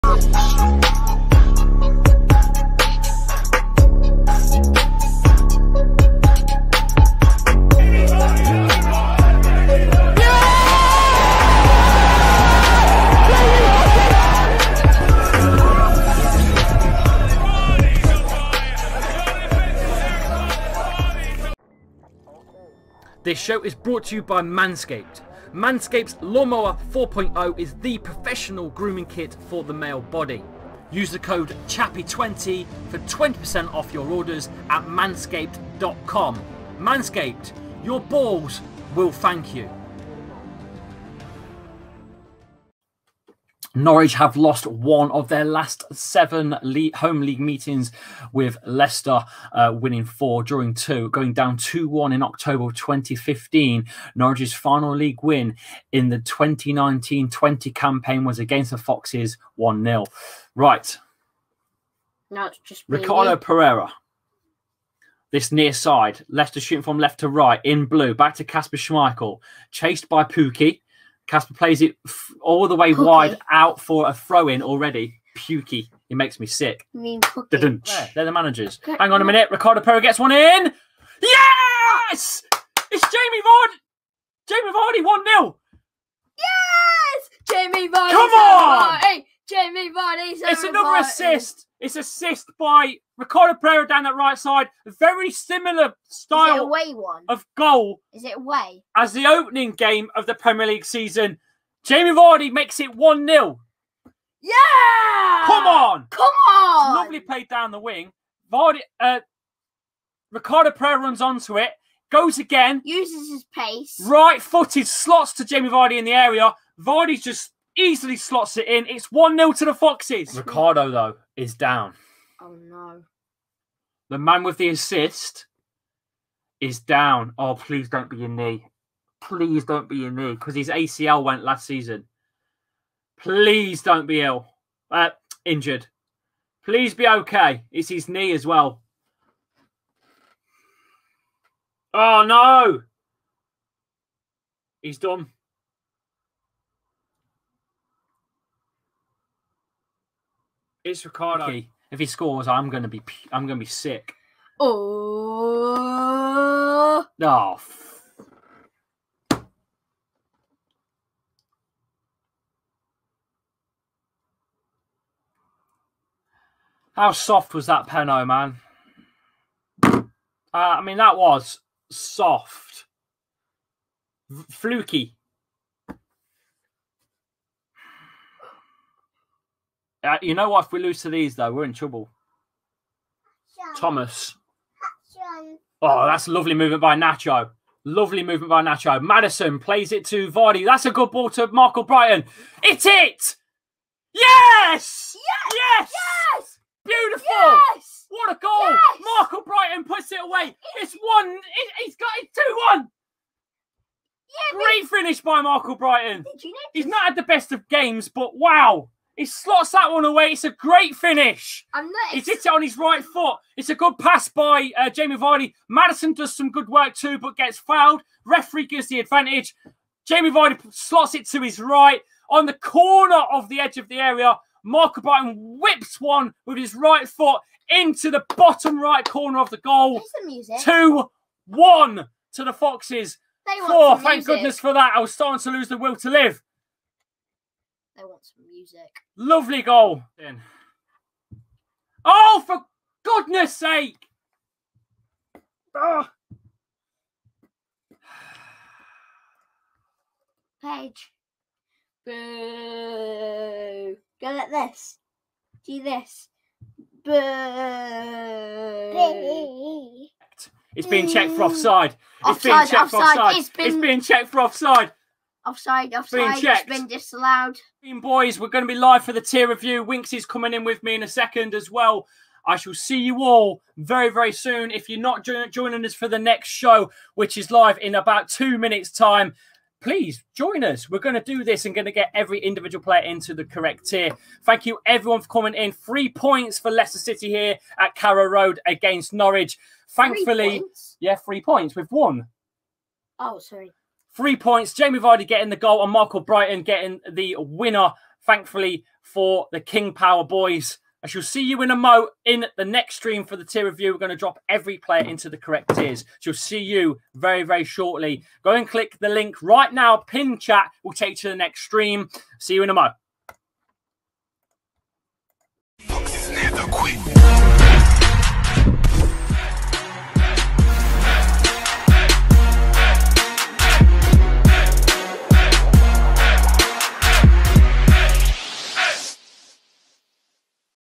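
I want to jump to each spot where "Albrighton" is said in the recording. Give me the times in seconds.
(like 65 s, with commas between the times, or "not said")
191 s, 199 s, 205 s, 224 s, 296 s.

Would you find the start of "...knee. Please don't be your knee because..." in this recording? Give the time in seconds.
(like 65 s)
128 s.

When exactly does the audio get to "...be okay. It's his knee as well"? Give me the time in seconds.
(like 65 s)
136 s.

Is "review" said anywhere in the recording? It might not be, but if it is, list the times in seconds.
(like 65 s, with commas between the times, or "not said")
269 s, 303 s.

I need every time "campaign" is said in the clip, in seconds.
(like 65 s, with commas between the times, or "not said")
57 s.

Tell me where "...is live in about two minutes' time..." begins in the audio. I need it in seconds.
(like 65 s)
277 s.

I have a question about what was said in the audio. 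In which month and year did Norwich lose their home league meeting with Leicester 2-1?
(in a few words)
October 2015.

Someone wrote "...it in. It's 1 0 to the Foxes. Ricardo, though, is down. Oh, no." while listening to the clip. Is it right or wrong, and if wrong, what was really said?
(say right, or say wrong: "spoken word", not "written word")
right.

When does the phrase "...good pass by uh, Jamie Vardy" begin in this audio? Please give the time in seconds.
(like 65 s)
213 s.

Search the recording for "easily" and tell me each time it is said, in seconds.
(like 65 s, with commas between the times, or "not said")
117 s.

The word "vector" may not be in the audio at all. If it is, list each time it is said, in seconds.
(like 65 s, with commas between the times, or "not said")
not said.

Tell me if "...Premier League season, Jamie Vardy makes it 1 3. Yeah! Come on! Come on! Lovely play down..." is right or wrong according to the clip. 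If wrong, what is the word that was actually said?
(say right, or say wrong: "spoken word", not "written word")
wrong: "0", not "3".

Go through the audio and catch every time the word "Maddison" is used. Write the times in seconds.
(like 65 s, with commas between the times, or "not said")
189 s, 215 s.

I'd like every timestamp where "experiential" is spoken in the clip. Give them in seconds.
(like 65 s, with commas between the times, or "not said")
not said.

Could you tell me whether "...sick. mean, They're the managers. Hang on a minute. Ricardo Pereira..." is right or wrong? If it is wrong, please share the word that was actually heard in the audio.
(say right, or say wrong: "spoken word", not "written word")
right.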